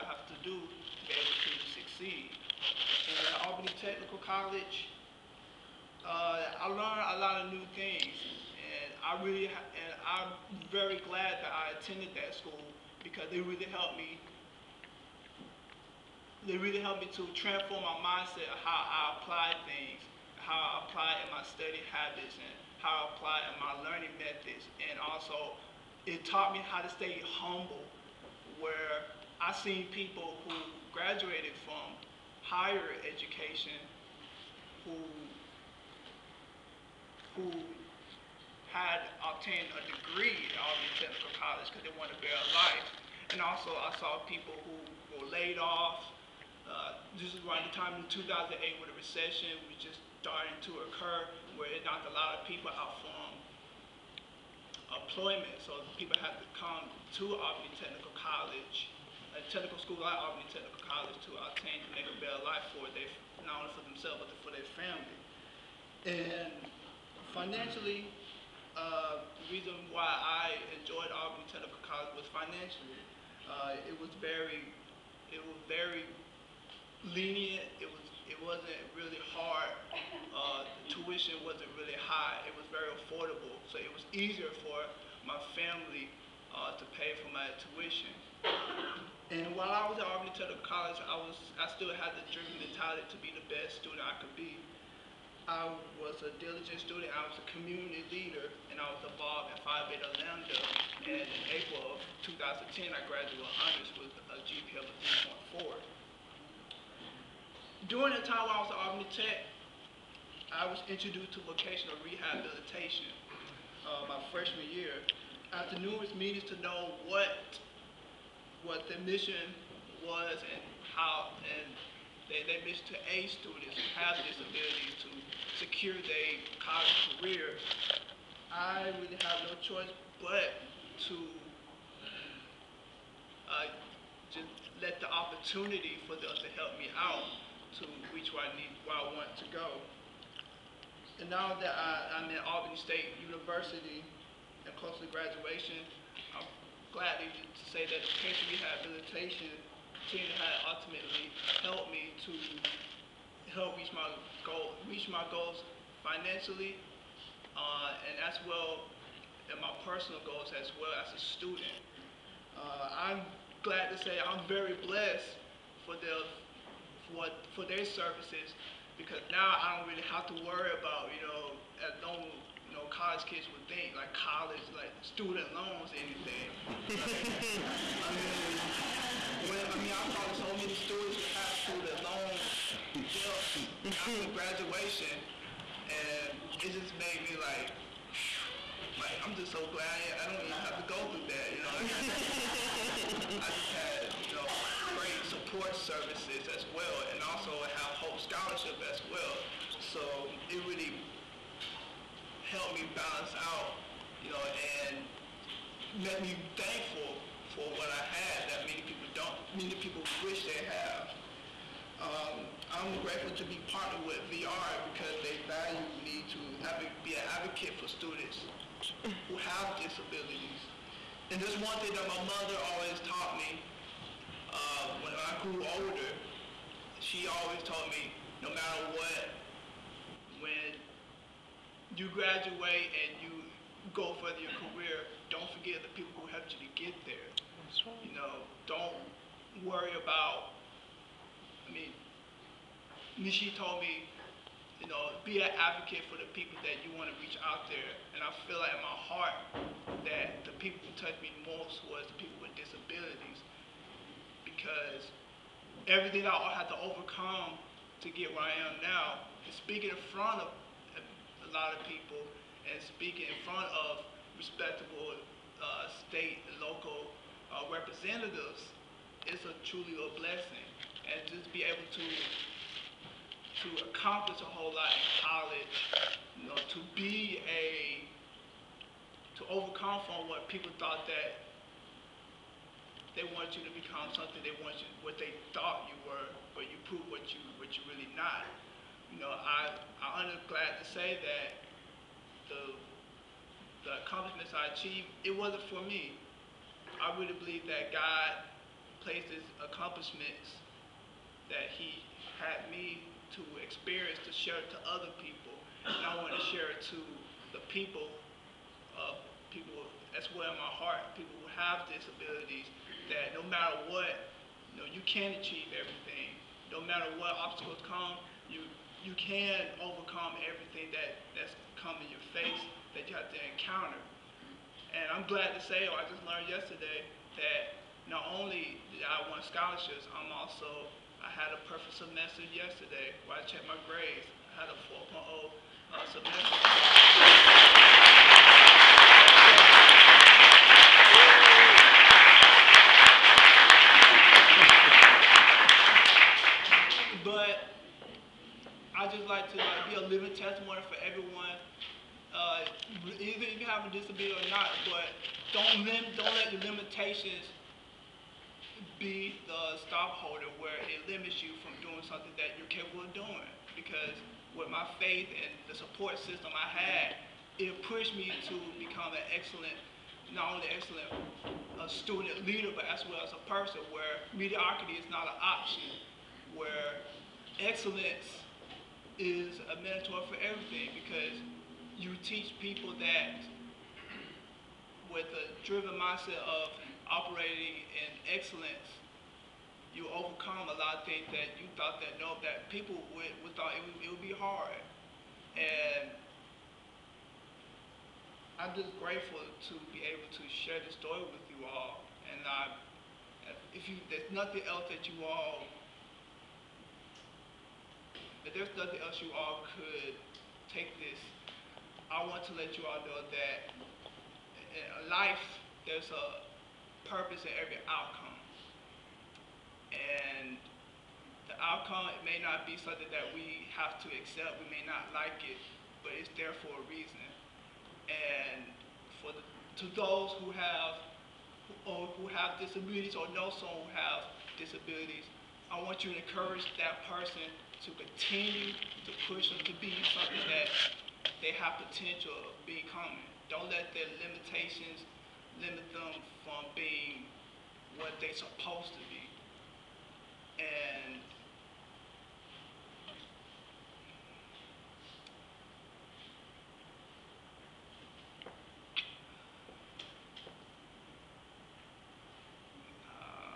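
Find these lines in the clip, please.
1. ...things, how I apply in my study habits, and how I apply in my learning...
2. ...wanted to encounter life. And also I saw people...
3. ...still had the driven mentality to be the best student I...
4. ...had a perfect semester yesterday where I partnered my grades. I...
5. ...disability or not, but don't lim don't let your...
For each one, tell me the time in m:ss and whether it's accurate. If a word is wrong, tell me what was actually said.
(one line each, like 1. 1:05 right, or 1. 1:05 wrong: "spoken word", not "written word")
1. 0:19 right
2. 0:41 wrong: "better", not "encounter"
3. 1:31 right
4. 5:31 wrong: "checked", not "partnered"
5. 5:53 right.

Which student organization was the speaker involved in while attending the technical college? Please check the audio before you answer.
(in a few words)
Phi Beta Lambda.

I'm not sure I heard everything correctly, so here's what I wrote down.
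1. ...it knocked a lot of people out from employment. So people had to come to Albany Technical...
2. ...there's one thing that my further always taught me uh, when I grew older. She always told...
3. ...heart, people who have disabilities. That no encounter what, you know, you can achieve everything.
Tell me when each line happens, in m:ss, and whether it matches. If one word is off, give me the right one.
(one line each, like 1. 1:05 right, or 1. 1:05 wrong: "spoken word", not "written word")
1. 0:51 right
2. 3:41 wrong: "mother", not "further"
3. 5:10 wrong: "matter", not "encounter".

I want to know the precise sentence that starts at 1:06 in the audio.
And financially, uh, the reason why I enjoyed Albany Technical College was financially.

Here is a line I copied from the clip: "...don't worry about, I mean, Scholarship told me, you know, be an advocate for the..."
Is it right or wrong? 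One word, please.
wrong.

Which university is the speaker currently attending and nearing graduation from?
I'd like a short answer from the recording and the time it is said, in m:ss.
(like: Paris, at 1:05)
Albany State University, at 2:22.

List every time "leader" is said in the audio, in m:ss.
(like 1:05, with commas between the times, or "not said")
1:38, 6:12.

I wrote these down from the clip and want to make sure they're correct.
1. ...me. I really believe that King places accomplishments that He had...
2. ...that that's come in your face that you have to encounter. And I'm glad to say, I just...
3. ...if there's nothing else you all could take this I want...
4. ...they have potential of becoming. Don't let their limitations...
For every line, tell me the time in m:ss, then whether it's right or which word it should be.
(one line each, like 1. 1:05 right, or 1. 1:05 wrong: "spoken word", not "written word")
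1. 4:55 wrong: "God", not "King"
2. 5:20 right
3. 6:48 right
4. 7:21 right.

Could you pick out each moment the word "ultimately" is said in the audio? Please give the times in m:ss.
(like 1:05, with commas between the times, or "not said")
2:30.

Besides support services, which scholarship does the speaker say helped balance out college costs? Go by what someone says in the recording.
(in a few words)
Hope Scholarship.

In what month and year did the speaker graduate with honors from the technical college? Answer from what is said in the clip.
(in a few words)
April 2010.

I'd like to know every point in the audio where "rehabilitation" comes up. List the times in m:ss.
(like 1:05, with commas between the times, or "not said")
1:52, 2:28.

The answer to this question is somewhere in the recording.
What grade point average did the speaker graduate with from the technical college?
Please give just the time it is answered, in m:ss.
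1:45.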